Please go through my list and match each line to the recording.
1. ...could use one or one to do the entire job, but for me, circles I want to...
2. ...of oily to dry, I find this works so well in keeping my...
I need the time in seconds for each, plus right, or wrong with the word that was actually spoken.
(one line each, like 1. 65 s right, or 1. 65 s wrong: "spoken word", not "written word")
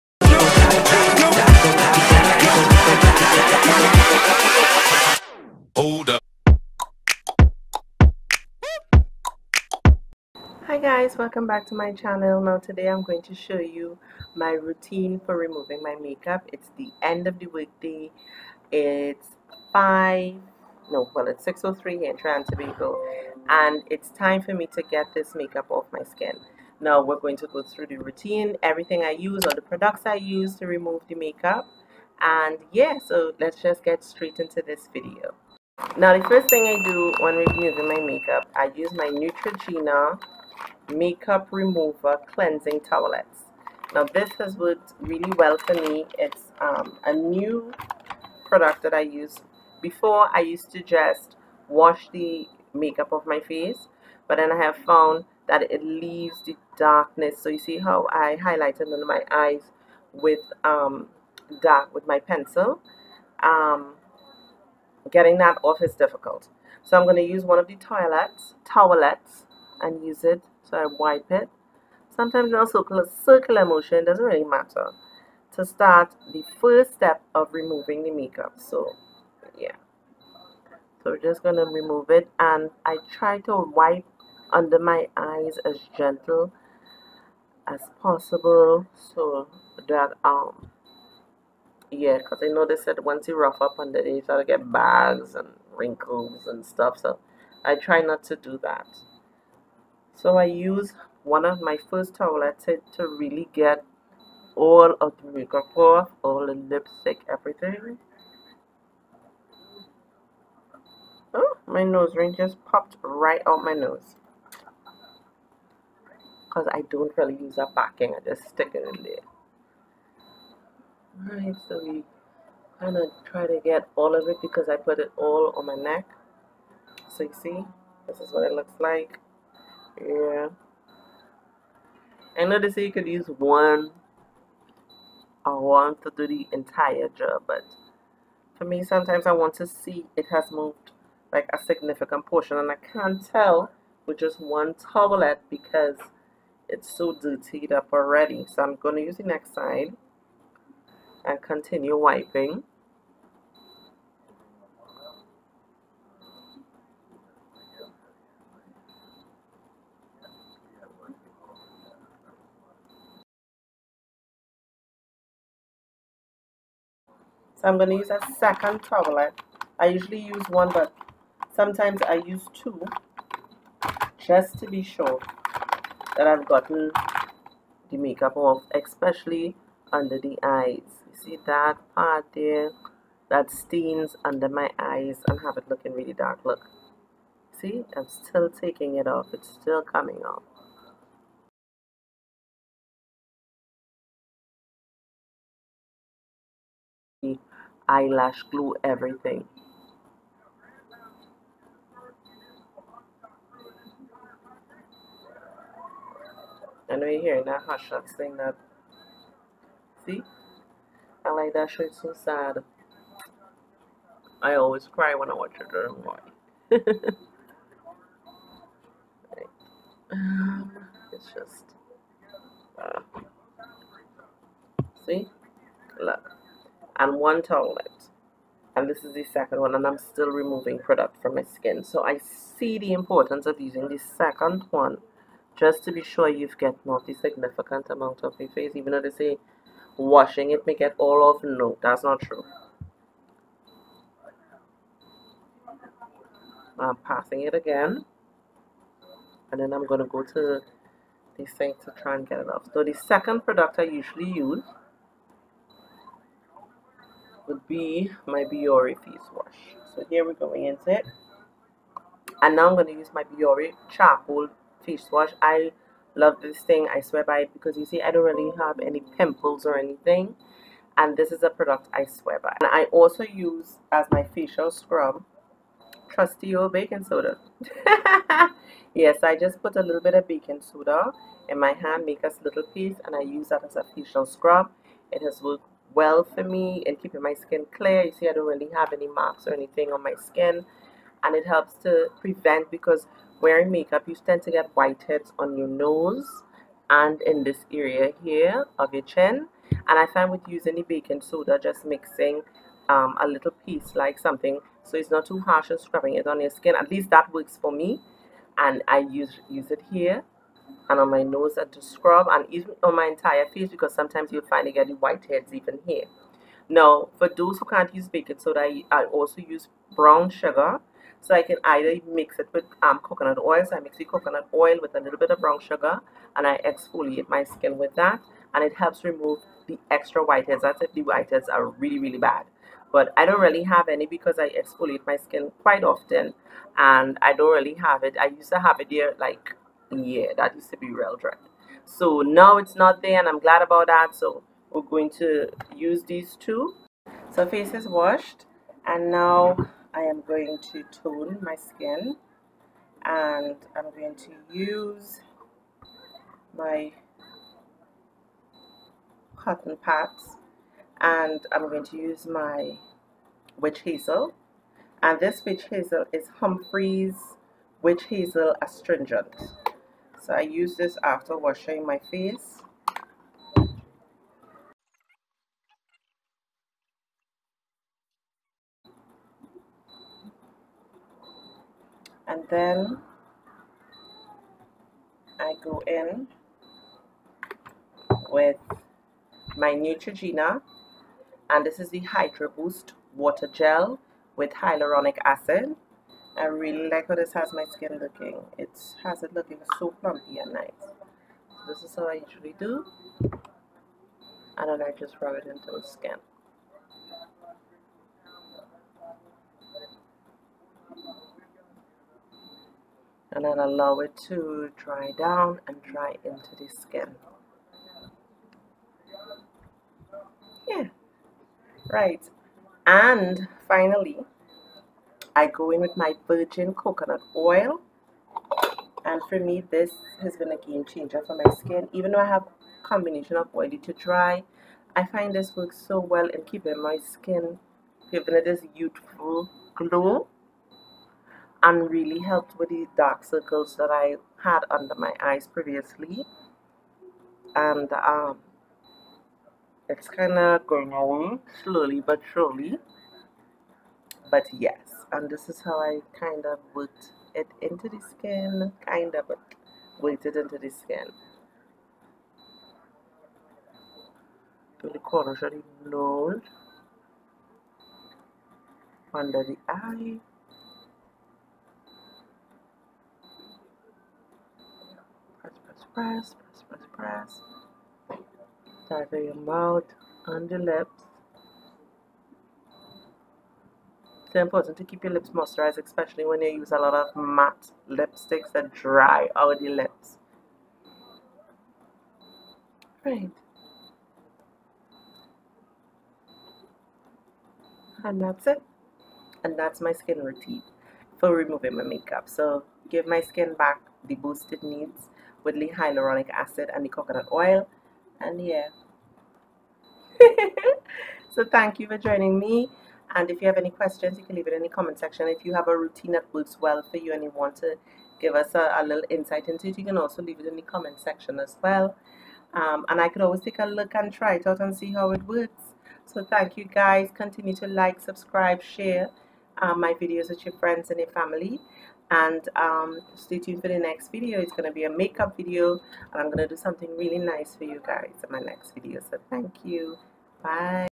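1. 132 s wrong: "sometimes", not "circles"
2. 433 s right.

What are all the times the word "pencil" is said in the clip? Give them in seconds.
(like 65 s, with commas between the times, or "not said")
62 s.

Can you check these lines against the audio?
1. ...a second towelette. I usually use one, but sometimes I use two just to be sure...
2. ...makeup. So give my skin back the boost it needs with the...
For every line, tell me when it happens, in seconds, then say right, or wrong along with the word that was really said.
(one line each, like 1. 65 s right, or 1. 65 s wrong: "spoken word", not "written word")
1. 168 s right
2. 501 s right.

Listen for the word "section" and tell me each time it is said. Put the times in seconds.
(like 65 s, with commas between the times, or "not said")
514 s, 520 s.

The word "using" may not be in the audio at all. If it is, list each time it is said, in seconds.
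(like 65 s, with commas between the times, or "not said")
233 s, 300 s.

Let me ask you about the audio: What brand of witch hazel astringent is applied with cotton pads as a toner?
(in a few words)
Humphreys.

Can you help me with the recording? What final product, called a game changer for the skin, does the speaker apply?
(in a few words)
virgin coconut oil.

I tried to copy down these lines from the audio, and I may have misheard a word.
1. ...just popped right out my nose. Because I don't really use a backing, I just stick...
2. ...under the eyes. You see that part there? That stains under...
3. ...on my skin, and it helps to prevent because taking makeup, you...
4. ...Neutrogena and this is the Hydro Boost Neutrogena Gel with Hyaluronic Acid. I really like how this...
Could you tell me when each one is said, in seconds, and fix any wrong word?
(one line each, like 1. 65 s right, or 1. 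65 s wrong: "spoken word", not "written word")
1. 112 s right
2. 179 s right
3. 289 s wrong: "wearing", not "taking"
4. 389 s wrong: "Water", not "Neutrogena".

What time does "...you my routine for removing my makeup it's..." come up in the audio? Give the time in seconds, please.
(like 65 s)
13 s.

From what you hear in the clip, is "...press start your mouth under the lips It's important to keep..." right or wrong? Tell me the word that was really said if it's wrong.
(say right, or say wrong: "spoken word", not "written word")
right.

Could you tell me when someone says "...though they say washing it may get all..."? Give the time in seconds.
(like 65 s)
238 s.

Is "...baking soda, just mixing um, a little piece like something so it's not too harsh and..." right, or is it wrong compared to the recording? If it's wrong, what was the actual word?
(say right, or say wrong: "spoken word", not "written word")
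right.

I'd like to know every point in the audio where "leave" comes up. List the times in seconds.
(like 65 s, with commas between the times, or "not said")
55 s, 514 s, 520 s.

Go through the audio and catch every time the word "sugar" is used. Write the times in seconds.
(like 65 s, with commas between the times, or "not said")
320 s, 325 s.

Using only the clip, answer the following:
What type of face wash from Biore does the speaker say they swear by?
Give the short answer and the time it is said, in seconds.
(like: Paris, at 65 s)
charcoal, at 263 s.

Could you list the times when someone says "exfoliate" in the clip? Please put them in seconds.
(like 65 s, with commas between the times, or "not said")
326 s, 334 s.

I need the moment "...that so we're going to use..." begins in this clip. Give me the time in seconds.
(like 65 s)
343 s.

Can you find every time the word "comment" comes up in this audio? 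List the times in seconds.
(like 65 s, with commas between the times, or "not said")
514 s, 520 s.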